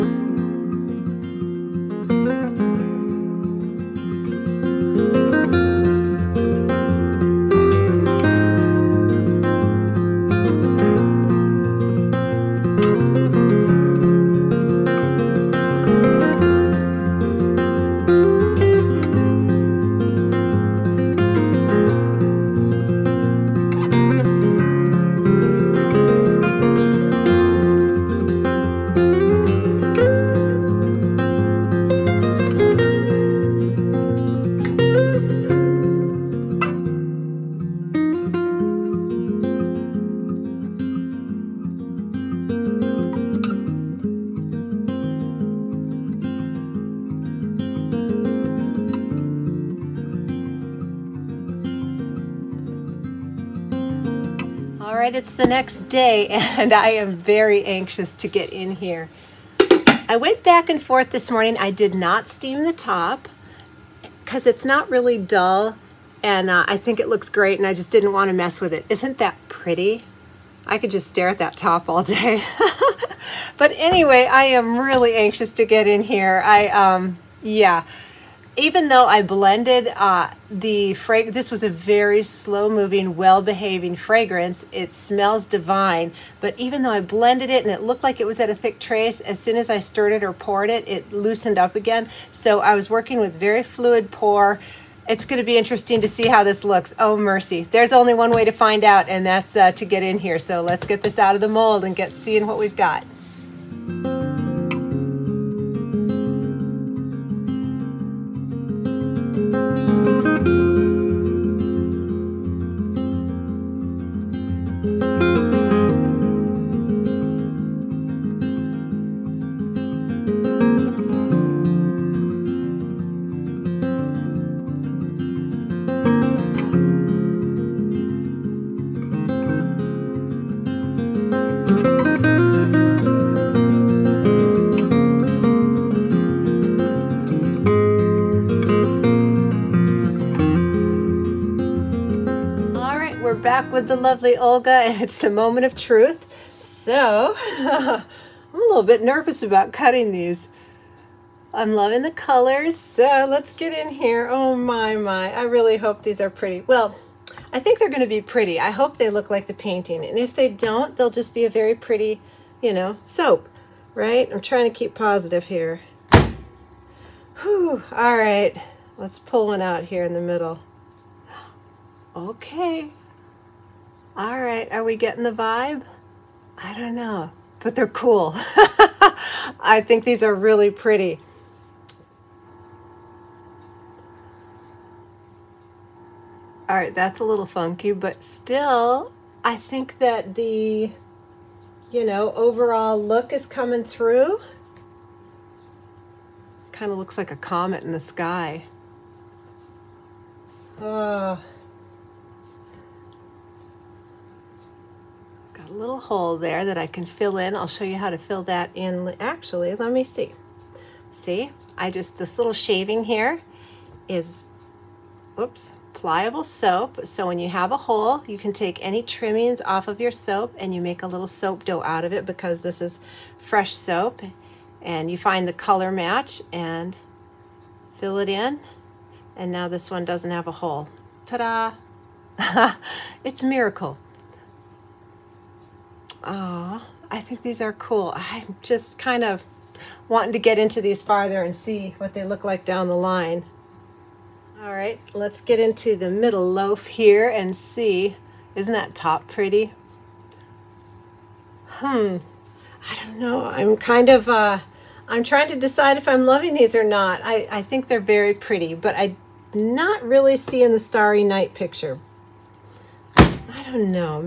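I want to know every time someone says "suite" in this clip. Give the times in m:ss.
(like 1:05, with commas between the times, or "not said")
not said.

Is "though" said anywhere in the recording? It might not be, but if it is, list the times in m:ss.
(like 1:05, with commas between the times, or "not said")
1:18, 1:26.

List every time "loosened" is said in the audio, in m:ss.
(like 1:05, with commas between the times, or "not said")
1:31.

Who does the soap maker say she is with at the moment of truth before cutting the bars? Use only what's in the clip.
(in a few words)
Olga.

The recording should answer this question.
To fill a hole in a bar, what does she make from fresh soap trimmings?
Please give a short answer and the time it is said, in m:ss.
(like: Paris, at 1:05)
soap dough, at 3:41.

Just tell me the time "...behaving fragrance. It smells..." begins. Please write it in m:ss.
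1:23.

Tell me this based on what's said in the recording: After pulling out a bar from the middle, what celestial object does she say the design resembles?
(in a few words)
a comet.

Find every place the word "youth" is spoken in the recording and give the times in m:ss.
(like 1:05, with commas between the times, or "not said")
not said.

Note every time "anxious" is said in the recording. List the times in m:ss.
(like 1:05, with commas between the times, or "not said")
0:57, 1:15.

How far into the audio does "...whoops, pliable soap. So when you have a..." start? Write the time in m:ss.
3:35.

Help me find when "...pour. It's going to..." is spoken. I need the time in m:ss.
1:34.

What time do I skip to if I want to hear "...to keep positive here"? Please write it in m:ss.
2:44.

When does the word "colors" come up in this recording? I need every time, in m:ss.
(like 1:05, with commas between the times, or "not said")
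2:32, 3:45.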